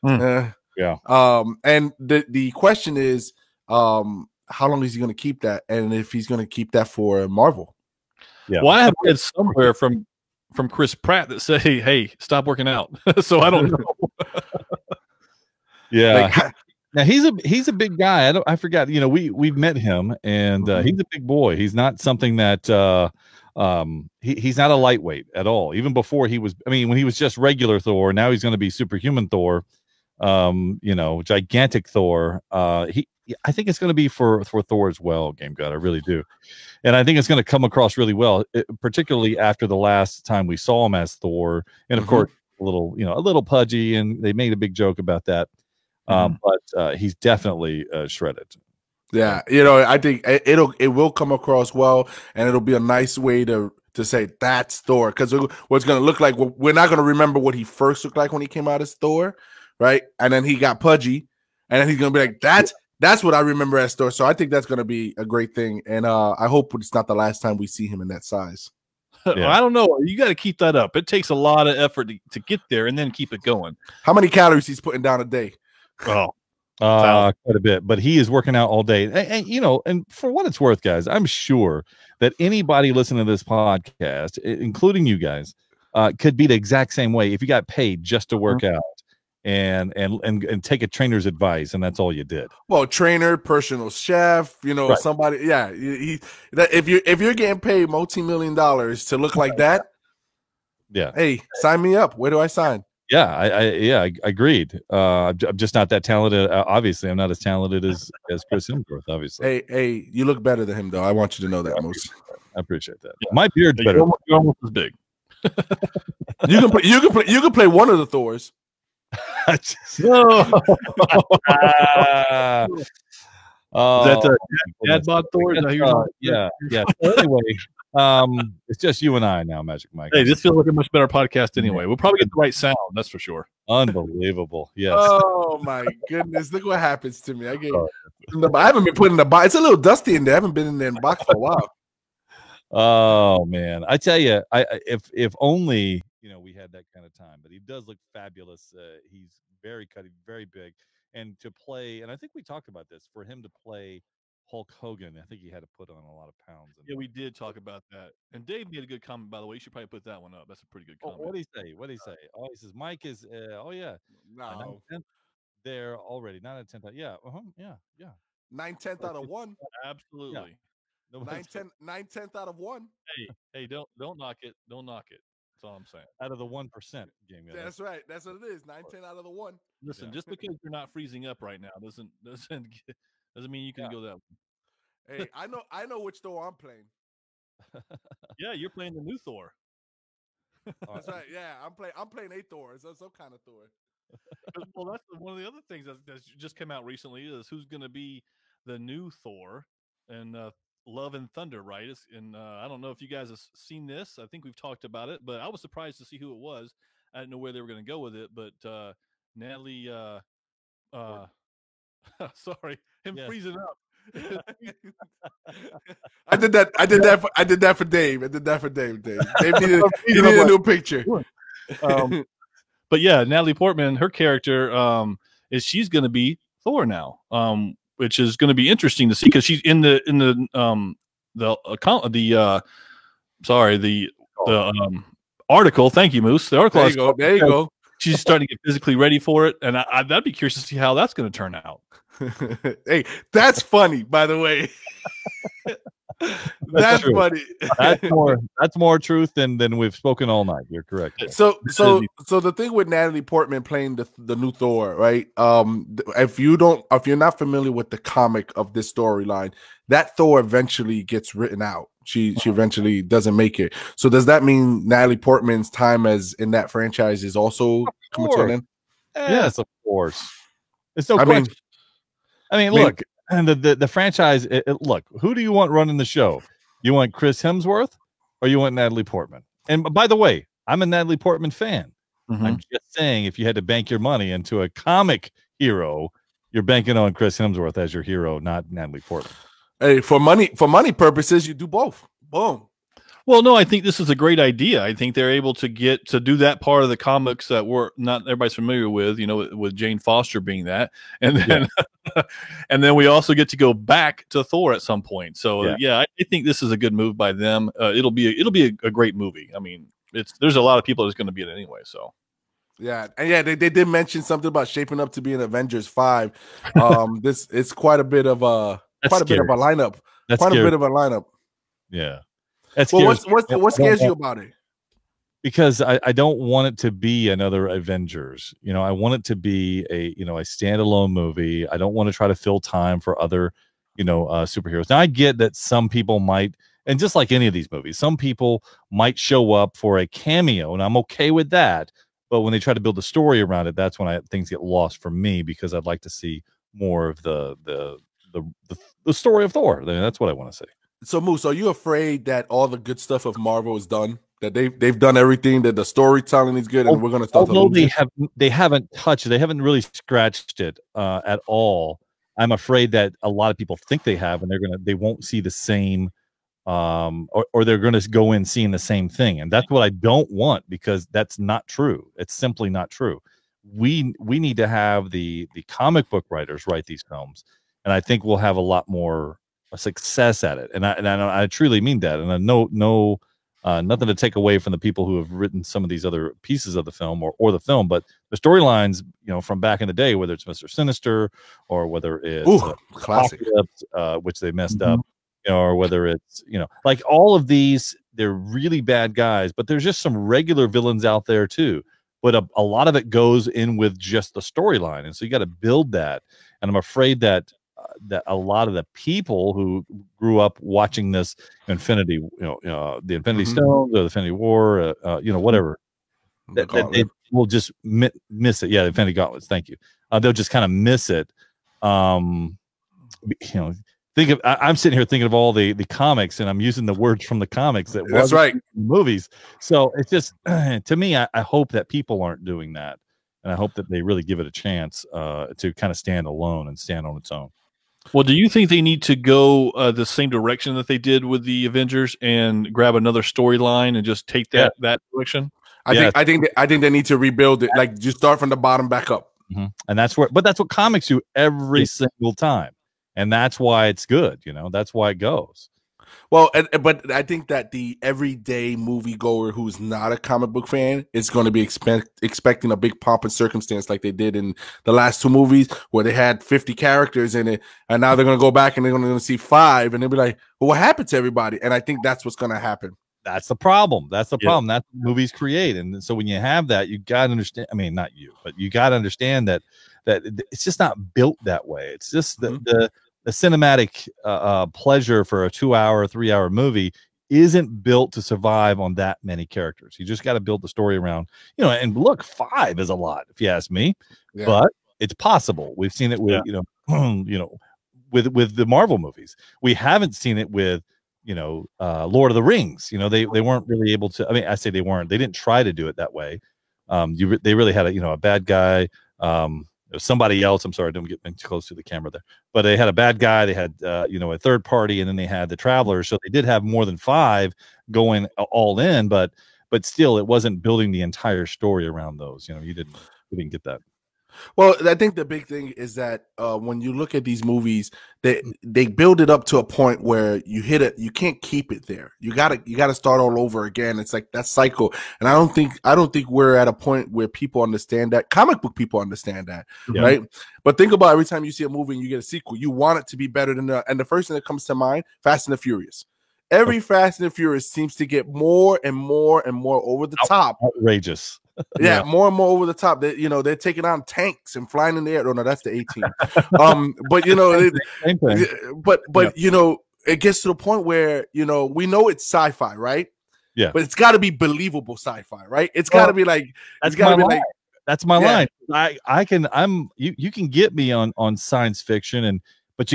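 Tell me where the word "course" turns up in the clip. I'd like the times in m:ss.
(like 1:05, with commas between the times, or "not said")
0:42, 4:29.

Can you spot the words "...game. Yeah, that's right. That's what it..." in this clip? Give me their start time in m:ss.
2:57.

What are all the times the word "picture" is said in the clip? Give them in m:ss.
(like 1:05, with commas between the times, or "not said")
3:40.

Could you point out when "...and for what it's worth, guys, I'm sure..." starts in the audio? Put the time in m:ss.
1:19.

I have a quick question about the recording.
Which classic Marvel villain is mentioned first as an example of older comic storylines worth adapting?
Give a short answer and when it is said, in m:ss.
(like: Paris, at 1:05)
Mister Sinister, at 6:30.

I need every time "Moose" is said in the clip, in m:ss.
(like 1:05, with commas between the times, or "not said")
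3:56, 5:51.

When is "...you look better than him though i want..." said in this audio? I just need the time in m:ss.
1:50.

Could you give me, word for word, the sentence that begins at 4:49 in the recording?
Hey, for money for money purposes, you do both.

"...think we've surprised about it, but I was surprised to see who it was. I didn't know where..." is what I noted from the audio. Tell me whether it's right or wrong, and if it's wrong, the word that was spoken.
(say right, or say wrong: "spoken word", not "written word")
wrong: "talked", not "surprised".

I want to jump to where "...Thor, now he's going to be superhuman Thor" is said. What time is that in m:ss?
0:27.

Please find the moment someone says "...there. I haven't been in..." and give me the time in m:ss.
2:20.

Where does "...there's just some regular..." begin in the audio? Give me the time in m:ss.
6:39.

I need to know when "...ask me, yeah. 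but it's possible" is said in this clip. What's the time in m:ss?
8:13.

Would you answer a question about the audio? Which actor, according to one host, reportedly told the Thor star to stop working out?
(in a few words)
Chris Pratt.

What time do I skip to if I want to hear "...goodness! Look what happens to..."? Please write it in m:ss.
2:16.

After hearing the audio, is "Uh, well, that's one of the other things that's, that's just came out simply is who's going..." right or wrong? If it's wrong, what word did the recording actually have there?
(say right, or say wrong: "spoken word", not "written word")
wrong: "recently", not "simply".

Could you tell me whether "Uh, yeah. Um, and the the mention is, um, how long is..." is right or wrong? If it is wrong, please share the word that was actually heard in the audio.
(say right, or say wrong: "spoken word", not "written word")
wrong: "question", not "mention".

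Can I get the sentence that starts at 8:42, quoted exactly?
You know, you didn't you didn't get that.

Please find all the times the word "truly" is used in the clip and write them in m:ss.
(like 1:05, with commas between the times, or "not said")
6:21.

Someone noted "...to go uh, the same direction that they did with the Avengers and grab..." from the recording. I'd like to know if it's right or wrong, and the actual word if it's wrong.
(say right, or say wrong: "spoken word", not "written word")
right.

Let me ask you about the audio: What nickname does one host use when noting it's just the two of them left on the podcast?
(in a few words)
Magic Mike.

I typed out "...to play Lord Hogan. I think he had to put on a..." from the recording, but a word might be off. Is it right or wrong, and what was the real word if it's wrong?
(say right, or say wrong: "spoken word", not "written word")
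wrong: "Hulk", not "Lord".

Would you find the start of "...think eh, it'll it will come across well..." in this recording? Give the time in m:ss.
0:49.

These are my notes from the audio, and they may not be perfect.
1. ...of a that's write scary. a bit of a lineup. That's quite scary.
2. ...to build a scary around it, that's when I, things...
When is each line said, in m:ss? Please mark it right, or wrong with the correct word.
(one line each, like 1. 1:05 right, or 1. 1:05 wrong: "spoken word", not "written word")
1. 5:18 wrong: "quite", not "write"
2. 5:42 wrong: "story", not "scary".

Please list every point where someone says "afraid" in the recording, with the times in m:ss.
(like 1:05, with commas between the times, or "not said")
5:51, 6:02, 6:46.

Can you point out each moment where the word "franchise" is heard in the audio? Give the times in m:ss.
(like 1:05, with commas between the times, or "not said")
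4:26, 4:33.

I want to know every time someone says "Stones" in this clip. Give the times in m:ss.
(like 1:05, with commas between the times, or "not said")
6:53.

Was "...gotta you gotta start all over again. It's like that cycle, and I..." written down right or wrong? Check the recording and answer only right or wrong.
right.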